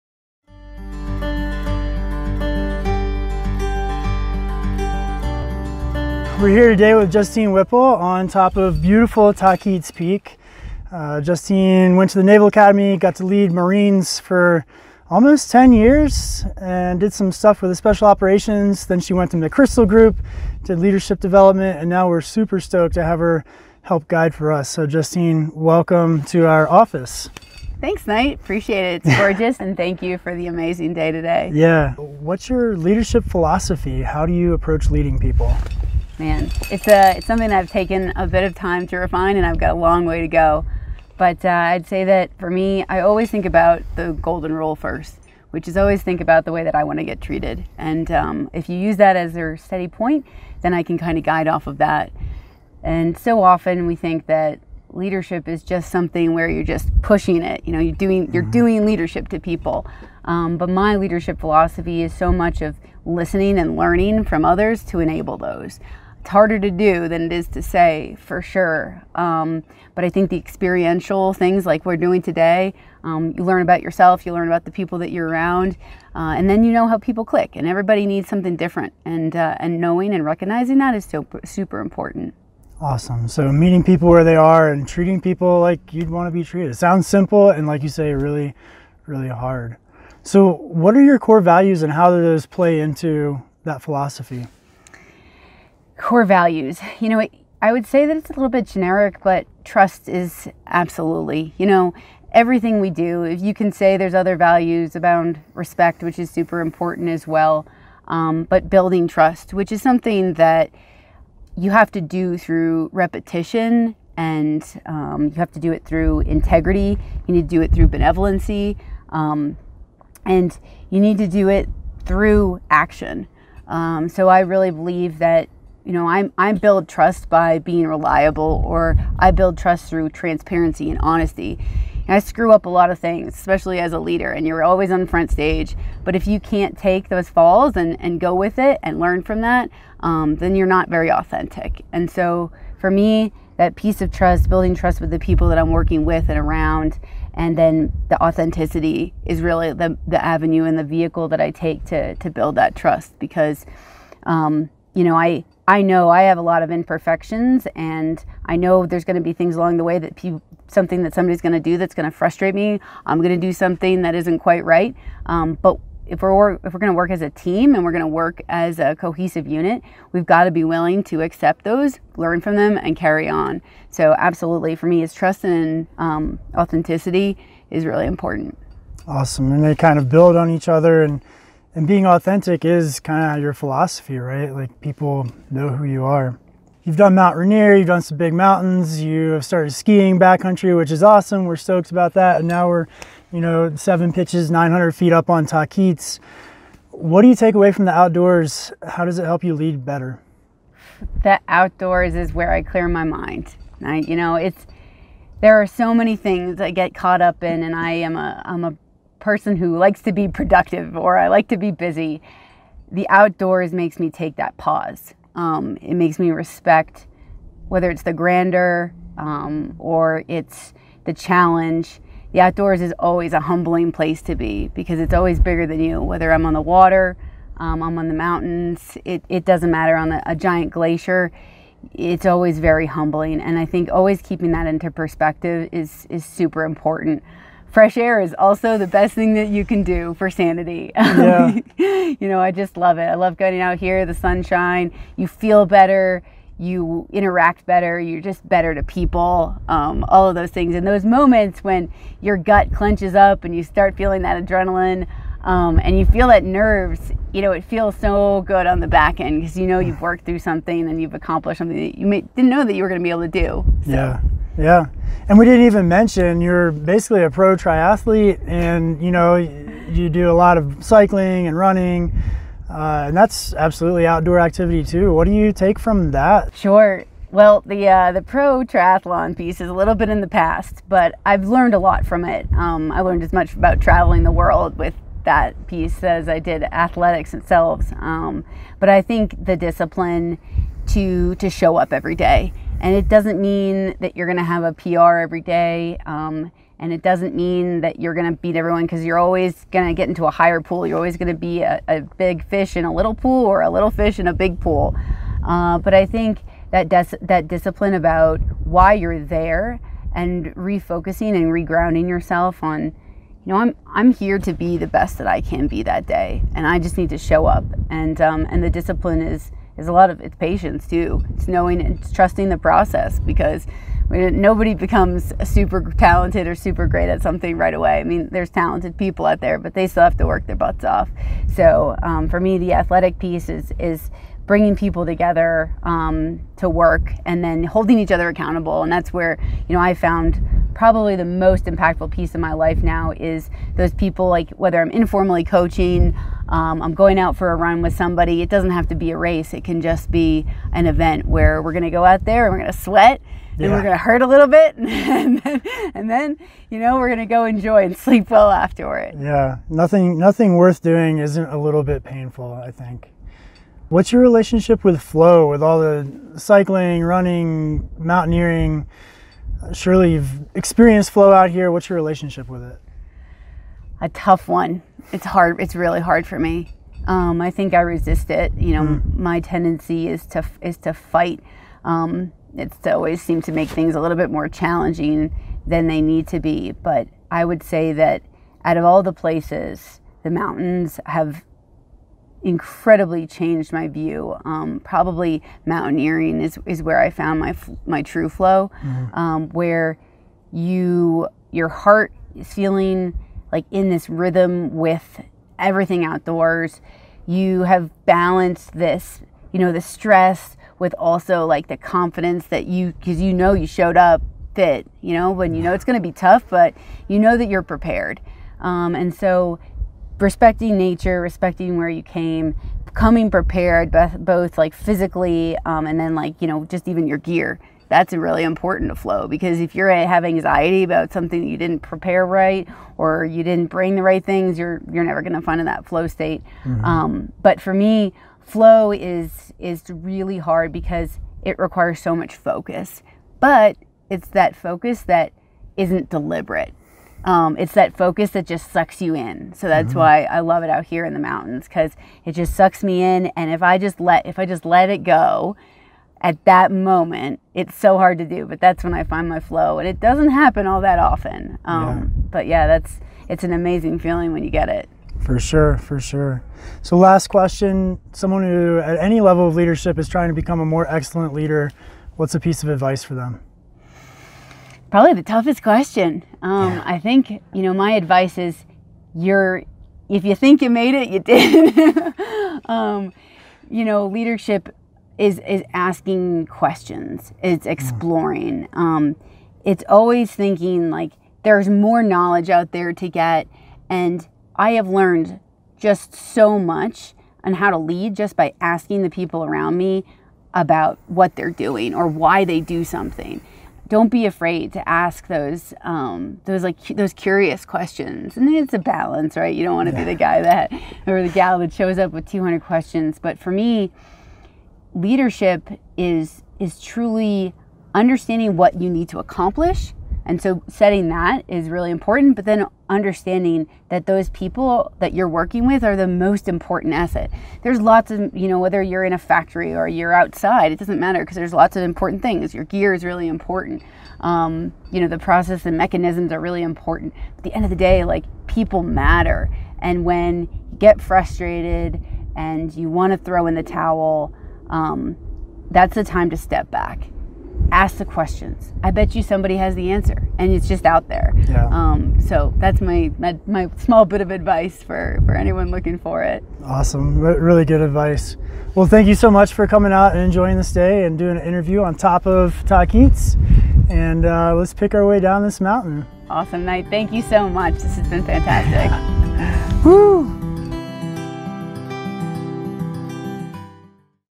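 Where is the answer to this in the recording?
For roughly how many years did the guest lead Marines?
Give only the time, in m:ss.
0:15.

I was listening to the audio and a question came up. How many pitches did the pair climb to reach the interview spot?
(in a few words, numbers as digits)
7.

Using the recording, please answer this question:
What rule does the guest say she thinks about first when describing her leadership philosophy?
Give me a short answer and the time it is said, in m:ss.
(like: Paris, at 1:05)
the golden rule, at 0:44.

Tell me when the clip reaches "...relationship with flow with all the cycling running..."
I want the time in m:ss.
6:04.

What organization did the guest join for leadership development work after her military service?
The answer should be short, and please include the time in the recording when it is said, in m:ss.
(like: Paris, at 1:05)
McChrystal Group, at 0:19.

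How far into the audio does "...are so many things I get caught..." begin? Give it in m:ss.
3:25.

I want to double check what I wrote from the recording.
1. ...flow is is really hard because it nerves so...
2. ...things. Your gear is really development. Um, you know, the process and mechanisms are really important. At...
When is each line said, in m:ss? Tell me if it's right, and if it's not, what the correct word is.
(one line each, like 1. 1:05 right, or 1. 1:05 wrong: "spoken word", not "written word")
1. 7:18 wrong: "requires", not "nerves"
2. 8:52 wrong: "important", not "development".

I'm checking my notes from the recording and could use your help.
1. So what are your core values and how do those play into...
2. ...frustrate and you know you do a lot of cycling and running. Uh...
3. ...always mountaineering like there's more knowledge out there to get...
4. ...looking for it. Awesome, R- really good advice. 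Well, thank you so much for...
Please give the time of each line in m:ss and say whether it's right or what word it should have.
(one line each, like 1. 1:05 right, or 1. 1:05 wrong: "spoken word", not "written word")
1. 1:30 right
2. 4:27 wrong: "triathlete", not "frustrate"
3. 8:09 wrong: "thinking", not "mountaineering"
4. 9:15 right.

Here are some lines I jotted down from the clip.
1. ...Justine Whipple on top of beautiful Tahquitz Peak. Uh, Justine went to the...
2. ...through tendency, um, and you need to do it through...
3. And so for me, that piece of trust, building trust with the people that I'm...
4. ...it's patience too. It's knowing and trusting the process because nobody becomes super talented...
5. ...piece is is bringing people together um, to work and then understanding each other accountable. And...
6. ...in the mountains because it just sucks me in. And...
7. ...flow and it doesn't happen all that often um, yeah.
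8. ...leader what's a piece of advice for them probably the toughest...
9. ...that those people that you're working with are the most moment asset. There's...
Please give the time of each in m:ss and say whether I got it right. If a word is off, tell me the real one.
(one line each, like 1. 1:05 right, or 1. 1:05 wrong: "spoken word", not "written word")
1. 0:07 right
2. 1:57 wrong: "benevolency", not "tendency"
3. 2:21 right
4. 5:20 right
5. 5:33 wrong: "holding", not "understanding"
6. 7:31 right
7. 7:39 right
8. 7:51 right
9. 8:43 wrong: "important", not "moment".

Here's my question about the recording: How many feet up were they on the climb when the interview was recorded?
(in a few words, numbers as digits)
900.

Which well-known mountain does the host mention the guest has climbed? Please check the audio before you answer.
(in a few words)
Mount Rainier.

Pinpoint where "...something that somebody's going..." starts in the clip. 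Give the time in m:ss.
2:40.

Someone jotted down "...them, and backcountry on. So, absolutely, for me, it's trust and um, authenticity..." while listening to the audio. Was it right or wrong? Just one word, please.
wrong.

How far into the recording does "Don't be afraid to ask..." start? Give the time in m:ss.
8:23.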